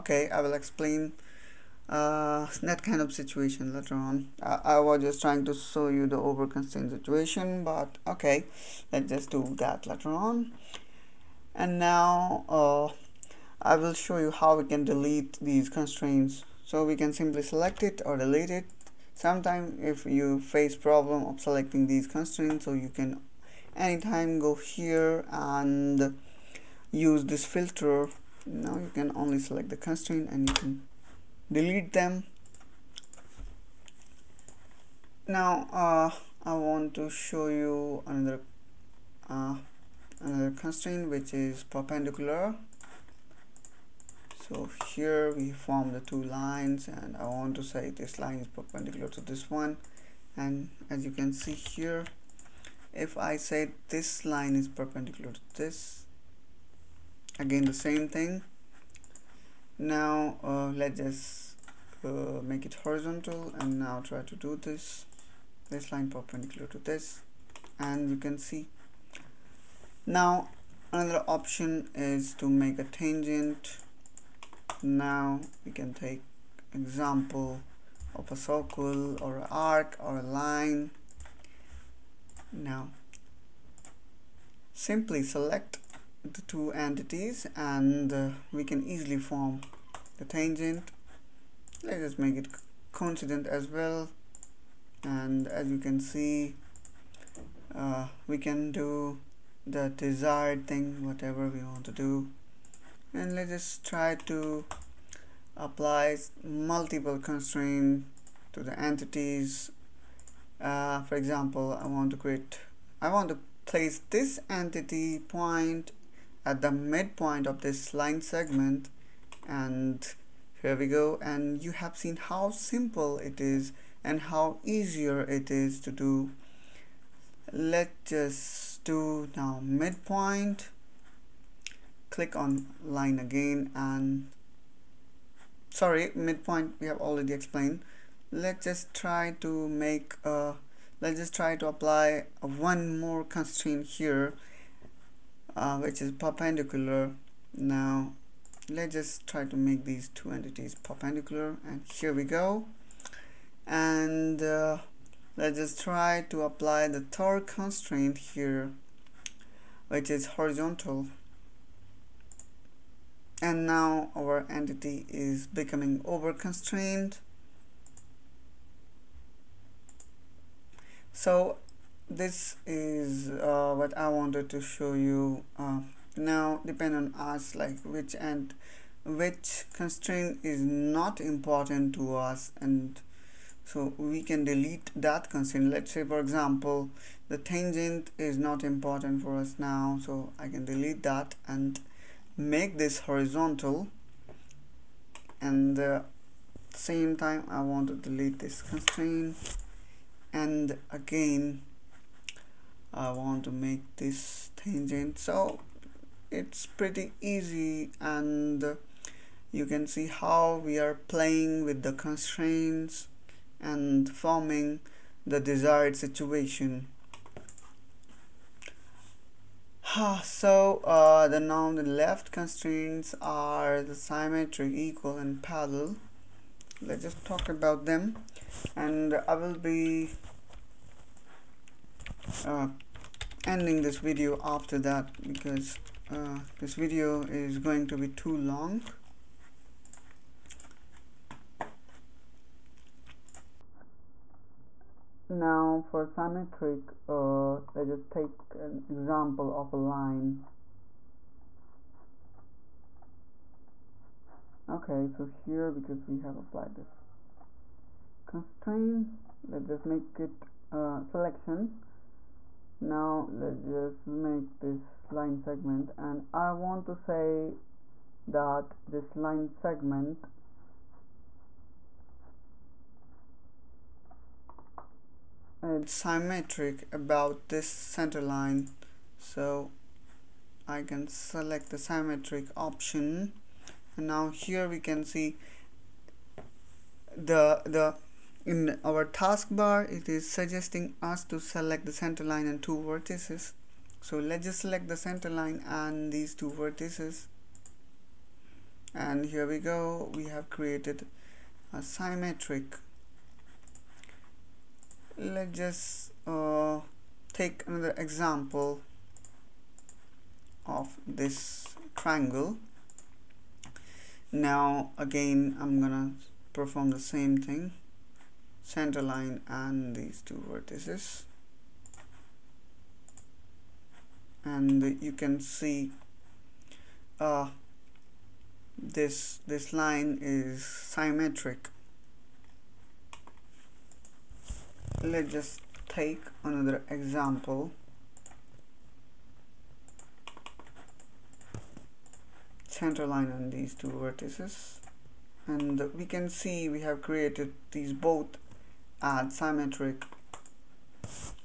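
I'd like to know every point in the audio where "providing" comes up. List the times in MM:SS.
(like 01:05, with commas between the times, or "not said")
not said.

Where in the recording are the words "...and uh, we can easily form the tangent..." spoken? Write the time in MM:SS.
01:27.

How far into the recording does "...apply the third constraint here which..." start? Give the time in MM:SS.
02:36.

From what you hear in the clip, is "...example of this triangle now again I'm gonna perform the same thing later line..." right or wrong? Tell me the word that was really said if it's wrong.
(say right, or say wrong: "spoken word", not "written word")
wrong: "center", not "later".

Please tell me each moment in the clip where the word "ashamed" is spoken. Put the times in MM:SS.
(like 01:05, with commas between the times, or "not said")
not said.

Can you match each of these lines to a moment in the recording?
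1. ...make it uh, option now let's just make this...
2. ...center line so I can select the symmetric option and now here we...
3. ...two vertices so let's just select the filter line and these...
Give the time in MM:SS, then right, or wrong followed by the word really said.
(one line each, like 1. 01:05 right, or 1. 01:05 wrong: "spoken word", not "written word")
1. 04:19 wrong: "selection", not "option"
2. 04:37 right
3. 04:52 wrong: "center", not "filter".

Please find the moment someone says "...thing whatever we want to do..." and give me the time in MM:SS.
01:40.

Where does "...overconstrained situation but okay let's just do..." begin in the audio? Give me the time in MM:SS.
00:06.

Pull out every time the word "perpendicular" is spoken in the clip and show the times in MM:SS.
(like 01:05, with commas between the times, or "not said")
00:41, 00:48, 00:54, 01:06, 02:26, 02:30.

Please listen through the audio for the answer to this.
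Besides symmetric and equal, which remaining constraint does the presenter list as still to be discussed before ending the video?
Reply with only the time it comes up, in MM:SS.
03:45.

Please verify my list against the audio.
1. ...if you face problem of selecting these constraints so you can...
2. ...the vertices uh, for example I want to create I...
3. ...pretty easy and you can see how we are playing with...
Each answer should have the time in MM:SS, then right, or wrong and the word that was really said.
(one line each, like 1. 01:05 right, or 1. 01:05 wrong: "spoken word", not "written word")
1. 00:19 right
2. 01:48 wrong: "entities", not "vertices"
3. 03:26 right.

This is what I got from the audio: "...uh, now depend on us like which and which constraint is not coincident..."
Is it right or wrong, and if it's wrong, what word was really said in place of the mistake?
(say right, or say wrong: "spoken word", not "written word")
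wrong: "important", not "coincident".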